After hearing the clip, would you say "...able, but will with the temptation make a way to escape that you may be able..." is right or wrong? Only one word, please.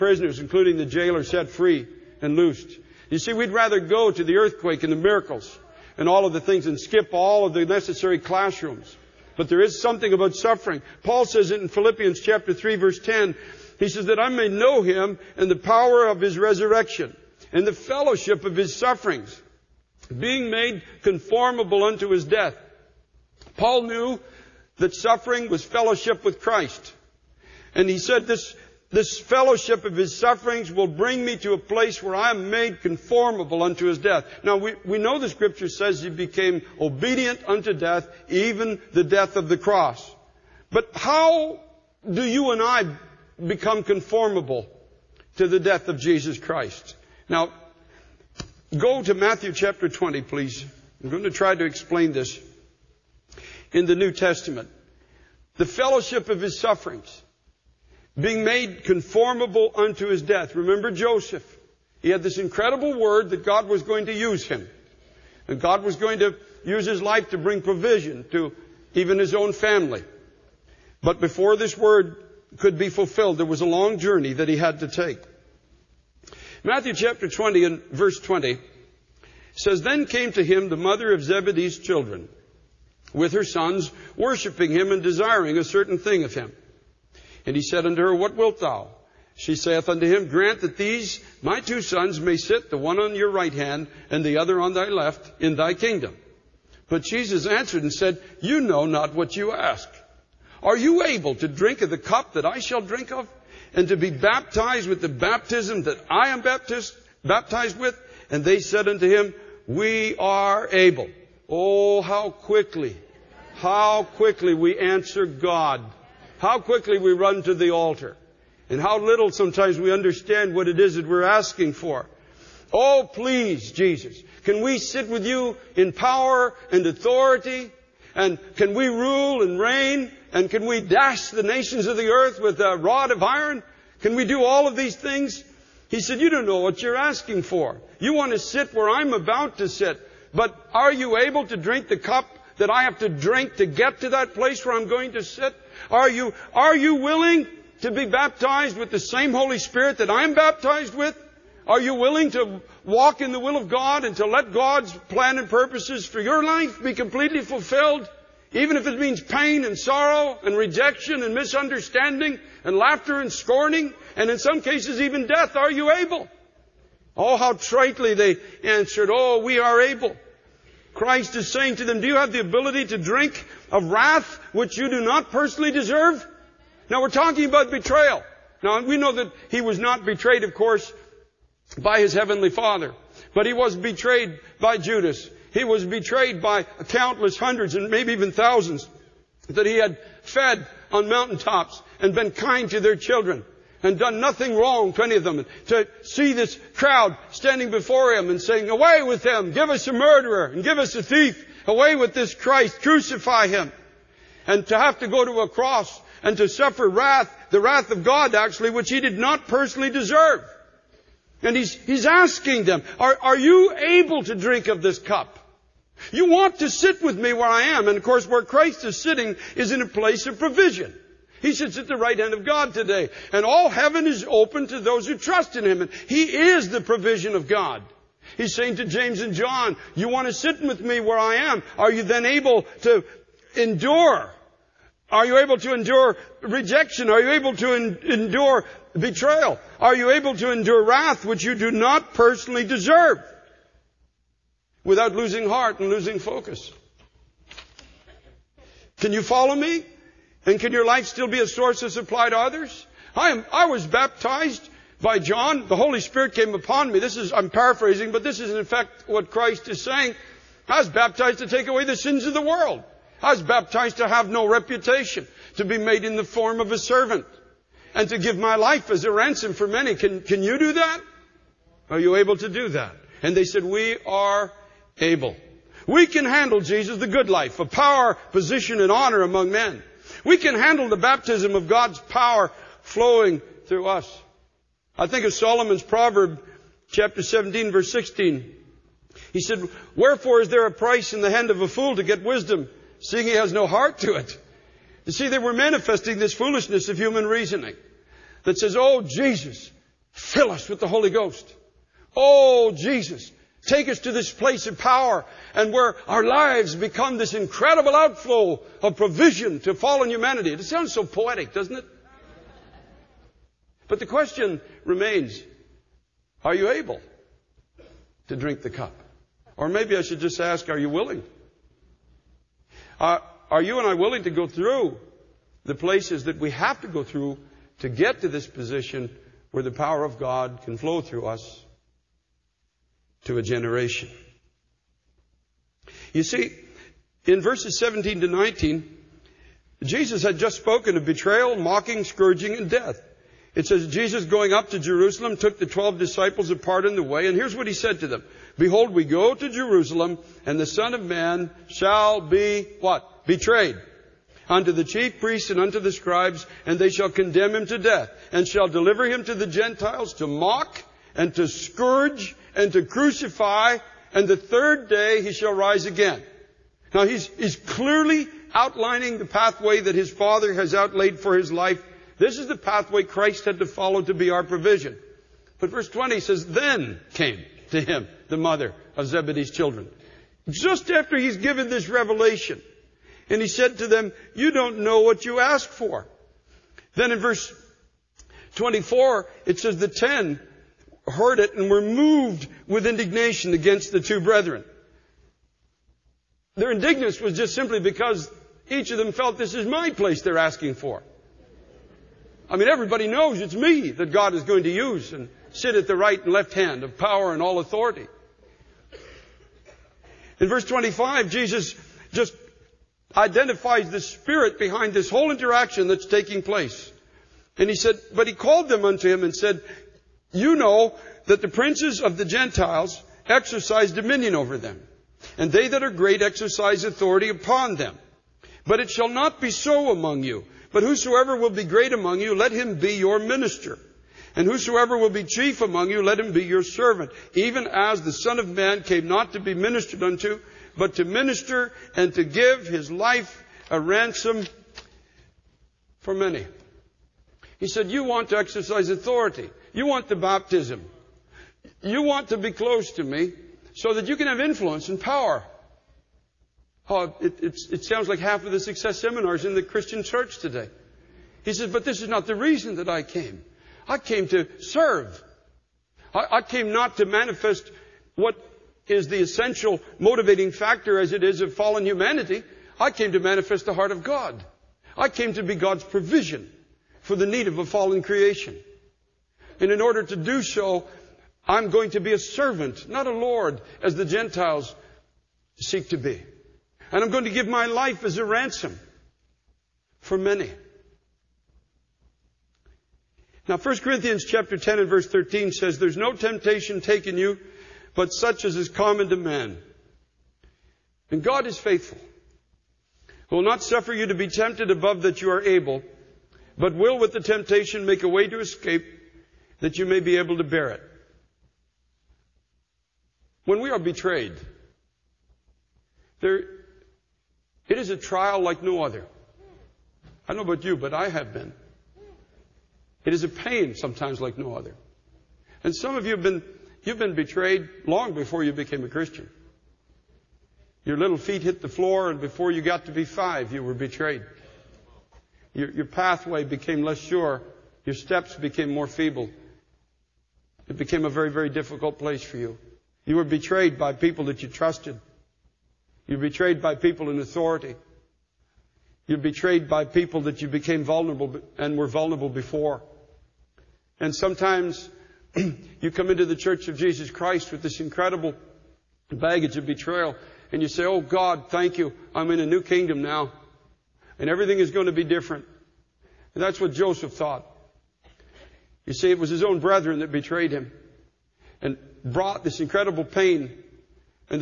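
right.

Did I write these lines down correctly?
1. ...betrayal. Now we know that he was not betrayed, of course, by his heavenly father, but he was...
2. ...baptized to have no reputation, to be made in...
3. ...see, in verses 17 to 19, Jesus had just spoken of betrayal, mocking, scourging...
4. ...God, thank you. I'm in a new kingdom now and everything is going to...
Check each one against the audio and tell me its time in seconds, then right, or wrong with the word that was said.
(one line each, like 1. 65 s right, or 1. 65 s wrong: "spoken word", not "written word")
1. 177 s right
2. 263 s right
3. 336 s right
4. 561 s right.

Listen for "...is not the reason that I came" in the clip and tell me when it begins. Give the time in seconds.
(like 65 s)
462 s.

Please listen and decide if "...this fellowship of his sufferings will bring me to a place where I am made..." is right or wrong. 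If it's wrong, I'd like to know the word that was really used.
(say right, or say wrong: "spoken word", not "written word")
right.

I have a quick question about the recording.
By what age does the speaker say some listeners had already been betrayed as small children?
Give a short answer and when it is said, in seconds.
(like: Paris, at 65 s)
5, at 533 s.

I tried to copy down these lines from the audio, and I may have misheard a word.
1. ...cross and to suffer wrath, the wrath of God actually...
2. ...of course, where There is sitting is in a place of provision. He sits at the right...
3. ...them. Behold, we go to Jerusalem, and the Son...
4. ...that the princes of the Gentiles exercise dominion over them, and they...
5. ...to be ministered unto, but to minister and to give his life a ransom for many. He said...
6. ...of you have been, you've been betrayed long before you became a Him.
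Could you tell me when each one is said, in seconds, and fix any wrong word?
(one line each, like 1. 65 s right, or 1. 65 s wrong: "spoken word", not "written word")
1. 205 s right
2. 217 s wrong: "Christ", not "There"
3. 348 s right
4. 421 s right
5. 439 s right
6. 525 s wrong: "Christian", not "Him".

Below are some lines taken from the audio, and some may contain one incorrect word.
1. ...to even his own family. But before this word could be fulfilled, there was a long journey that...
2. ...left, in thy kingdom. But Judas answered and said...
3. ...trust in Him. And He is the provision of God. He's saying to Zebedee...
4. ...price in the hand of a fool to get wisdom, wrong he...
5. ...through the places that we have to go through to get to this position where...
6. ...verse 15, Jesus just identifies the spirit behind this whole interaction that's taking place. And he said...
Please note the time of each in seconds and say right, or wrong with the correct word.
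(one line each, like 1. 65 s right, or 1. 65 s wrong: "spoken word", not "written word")
1. 68 s right
2. 94 s wrong: "Jesus", not "Judas"
3. 225 s wrong: "James", not "Zebedee"
4. 290 s wrong: "seeing", not "wrong"
5. 324 s right
6. 410 s wrong: "25", not "15".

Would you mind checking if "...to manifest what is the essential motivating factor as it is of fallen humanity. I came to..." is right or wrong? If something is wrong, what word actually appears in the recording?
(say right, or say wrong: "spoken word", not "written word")
right.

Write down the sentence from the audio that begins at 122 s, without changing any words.
Oh, please, Jesus, can we sit with you in power and authority?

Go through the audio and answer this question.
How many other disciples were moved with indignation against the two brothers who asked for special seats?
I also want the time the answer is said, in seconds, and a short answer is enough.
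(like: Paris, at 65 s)
10, at 389 s.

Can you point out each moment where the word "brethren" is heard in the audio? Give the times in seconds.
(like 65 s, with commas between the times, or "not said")
394 s, 569 s.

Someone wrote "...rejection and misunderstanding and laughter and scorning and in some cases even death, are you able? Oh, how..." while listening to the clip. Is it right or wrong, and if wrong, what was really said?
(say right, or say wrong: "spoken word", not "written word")
right.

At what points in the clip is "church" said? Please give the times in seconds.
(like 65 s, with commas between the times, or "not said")
460 s, 556 s.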